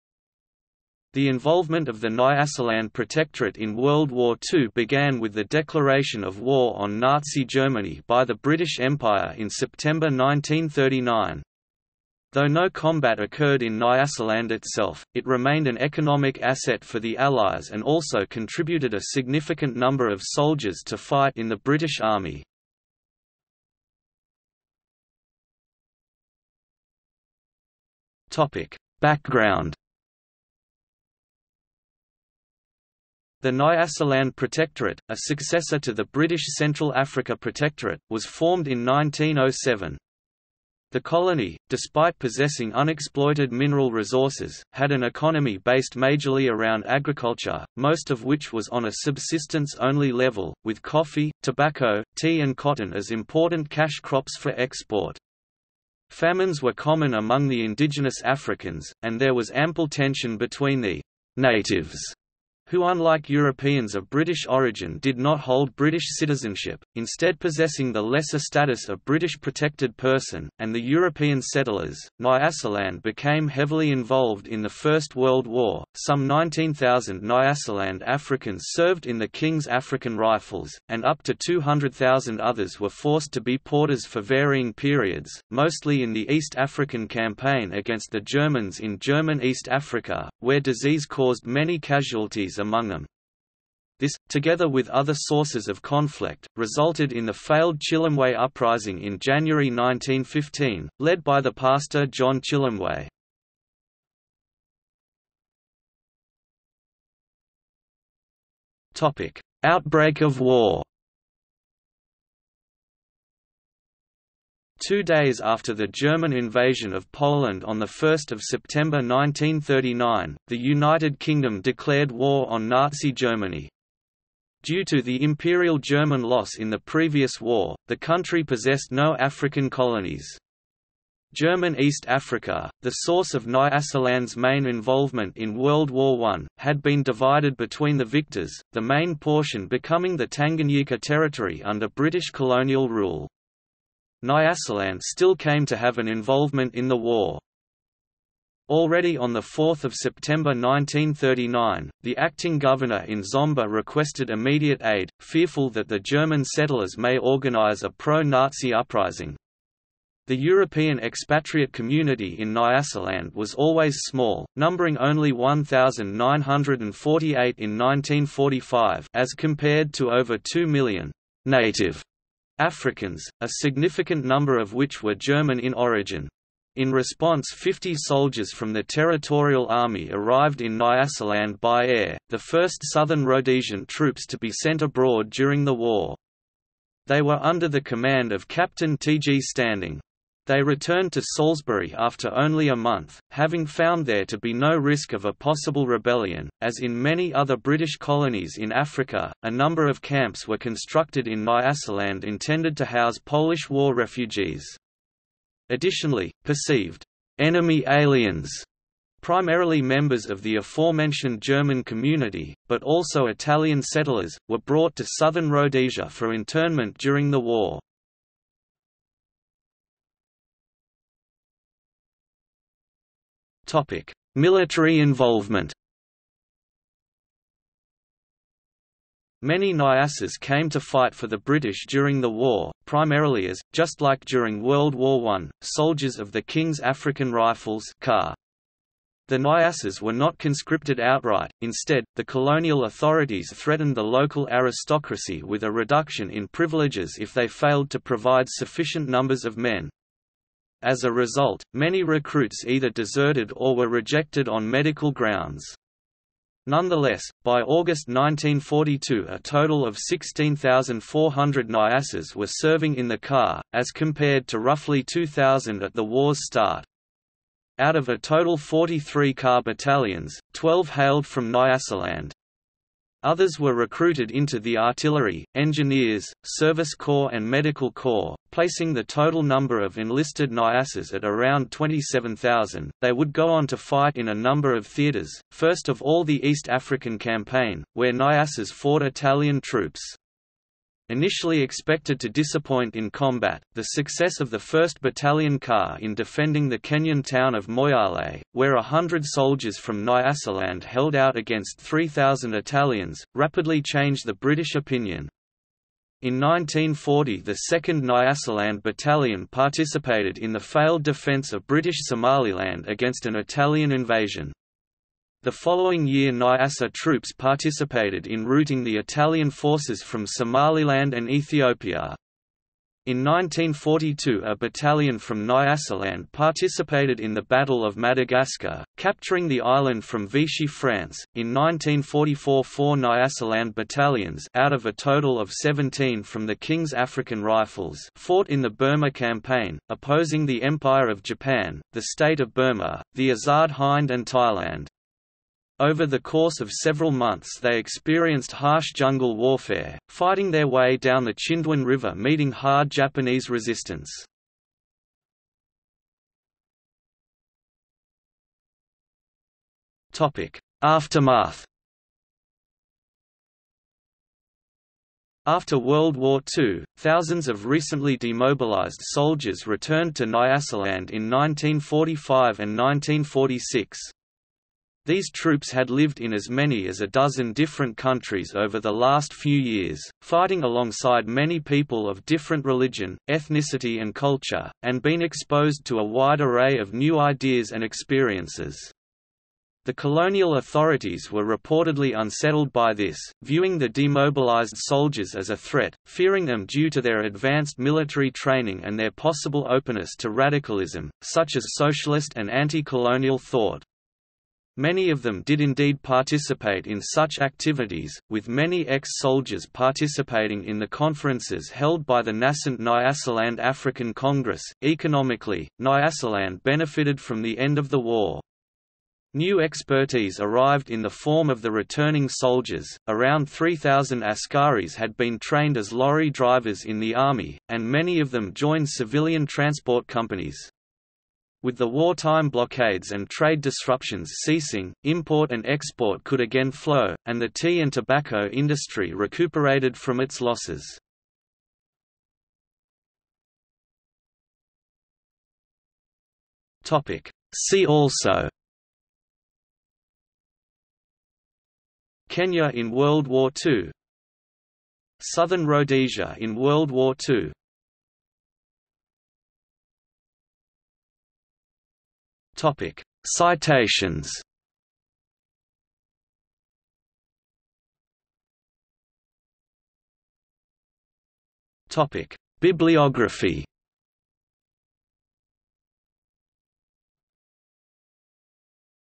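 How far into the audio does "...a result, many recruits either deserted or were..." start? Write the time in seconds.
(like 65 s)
251 s.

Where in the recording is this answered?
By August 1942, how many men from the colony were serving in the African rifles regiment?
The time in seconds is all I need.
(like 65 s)
259 s.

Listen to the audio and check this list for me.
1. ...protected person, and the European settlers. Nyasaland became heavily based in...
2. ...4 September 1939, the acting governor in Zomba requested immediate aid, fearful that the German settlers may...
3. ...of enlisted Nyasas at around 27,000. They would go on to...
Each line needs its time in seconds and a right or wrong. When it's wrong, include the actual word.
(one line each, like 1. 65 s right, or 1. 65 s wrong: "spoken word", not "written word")
1. 69 s wrong: "involved", not "based"
2. 149 s right
3. 279 s right.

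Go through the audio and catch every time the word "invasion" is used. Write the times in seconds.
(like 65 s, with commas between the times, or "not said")
116 s, 313 s.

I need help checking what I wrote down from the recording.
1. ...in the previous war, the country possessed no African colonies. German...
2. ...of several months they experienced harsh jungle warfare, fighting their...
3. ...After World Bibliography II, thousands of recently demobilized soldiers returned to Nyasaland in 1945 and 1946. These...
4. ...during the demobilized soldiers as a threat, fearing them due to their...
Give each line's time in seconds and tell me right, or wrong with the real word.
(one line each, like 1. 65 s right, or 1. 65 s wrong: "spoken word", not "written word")
1. 126 s right
2. 346 s right
3. 365 s wrong: "War", not "Bibliography"
4. 393 s wrong: "viewing", not "during".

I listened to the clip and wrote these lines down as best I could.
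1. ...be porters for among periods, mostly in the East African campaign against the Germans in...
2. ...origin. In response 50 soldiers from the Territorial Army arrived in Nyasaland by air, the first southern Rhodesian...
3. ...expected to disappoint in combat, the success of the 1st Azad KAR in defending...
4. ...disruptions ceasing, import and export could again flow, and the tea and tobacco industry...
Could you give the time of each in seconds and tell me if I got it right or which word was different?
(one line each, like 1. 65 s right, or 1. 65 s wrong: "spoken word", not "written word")
1. 83 s wrong: "varying", not "among"
2. 175 s right
3. 291 s wrong: "Battalion", not "Azad"
4. 433 s right.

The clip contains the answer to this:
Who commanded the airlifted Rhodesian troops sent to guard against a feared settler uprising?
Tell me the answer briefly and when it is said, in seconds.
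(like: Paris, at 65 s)
T. G. Standing, at 188 s.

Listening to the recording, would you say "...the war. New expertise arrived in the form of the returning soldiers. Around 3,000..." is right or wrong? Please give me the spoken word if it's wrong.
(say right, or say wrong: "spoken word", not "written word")
right.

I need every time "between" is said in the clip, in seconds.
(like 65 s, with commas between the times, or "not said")
60 s, 137 s.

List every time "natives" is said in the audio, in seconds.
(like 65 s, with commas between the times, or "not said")
61 s, 171 s.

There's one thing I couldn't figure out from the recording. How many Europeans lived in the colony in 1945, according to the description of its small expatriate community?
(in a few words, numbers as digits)
1,948.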